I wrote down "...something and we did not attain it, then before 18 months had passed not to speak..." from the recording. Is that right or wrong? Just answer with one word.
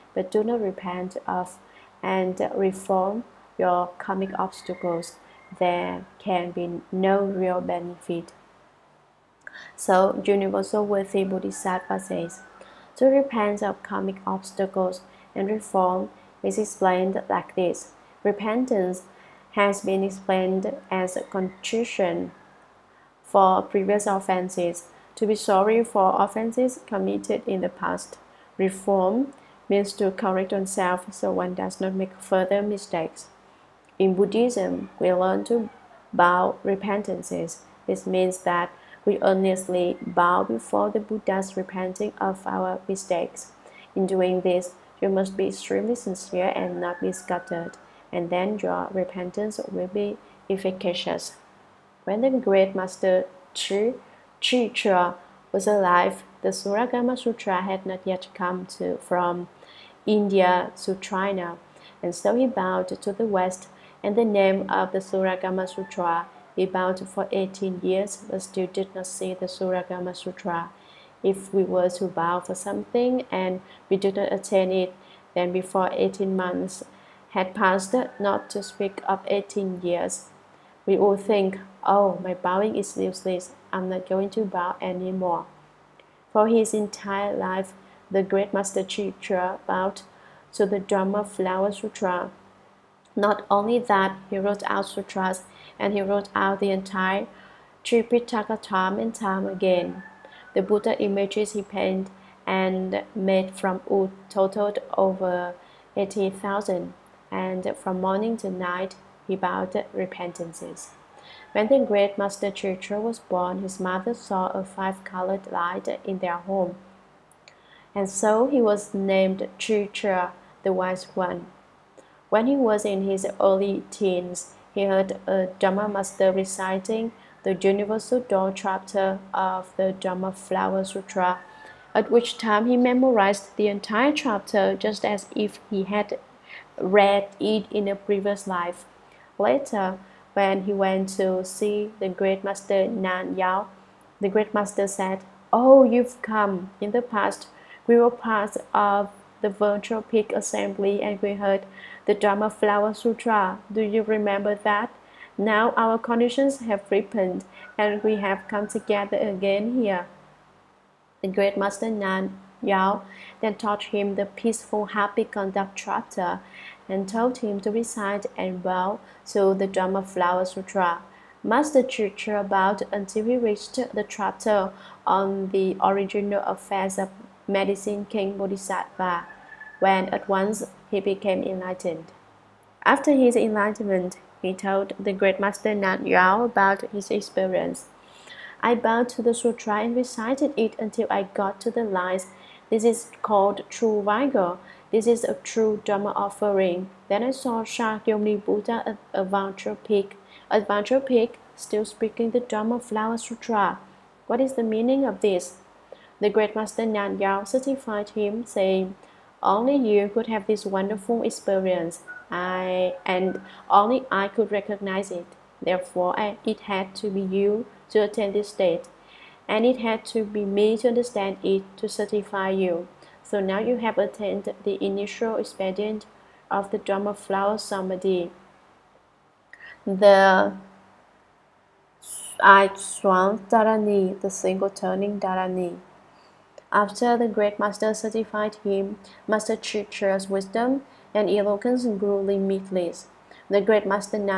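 right.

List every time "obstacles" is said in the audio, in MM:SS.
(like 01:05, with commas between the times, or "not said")
00:04, 00:14.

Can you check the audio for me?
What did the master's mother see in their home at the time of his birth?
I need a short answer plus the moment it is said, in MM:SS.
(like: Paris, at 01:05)
A five-colored light, at 01:54.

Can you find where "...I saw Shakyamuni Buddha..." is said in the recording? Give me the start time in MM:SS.
03:17.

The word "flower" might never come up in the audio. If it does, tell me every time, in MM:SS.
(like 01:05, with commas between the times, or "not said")
01:31, 02:10, 02:32, 02:50, 03:22, 03:47.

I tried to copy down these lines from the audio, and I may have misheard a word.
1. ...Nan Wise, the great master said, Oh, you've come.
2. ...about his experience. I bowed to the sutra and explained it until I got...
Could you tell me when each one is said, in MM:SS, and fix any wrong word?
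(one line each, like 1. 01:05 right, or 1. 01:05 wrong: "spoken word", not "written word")
1. 02:22 wrong: "Yue", not "Wise"
2. 03:06 wrong: "recited", not "explained".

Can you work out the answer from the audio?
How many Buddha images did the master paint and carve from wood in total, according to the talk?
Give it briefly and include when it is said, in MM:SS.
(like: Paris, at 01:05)
Over 80,000, at 01:44.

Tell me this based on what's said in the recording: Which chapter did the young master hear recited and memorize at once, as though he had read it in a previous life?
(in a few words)
Universal Door chapter.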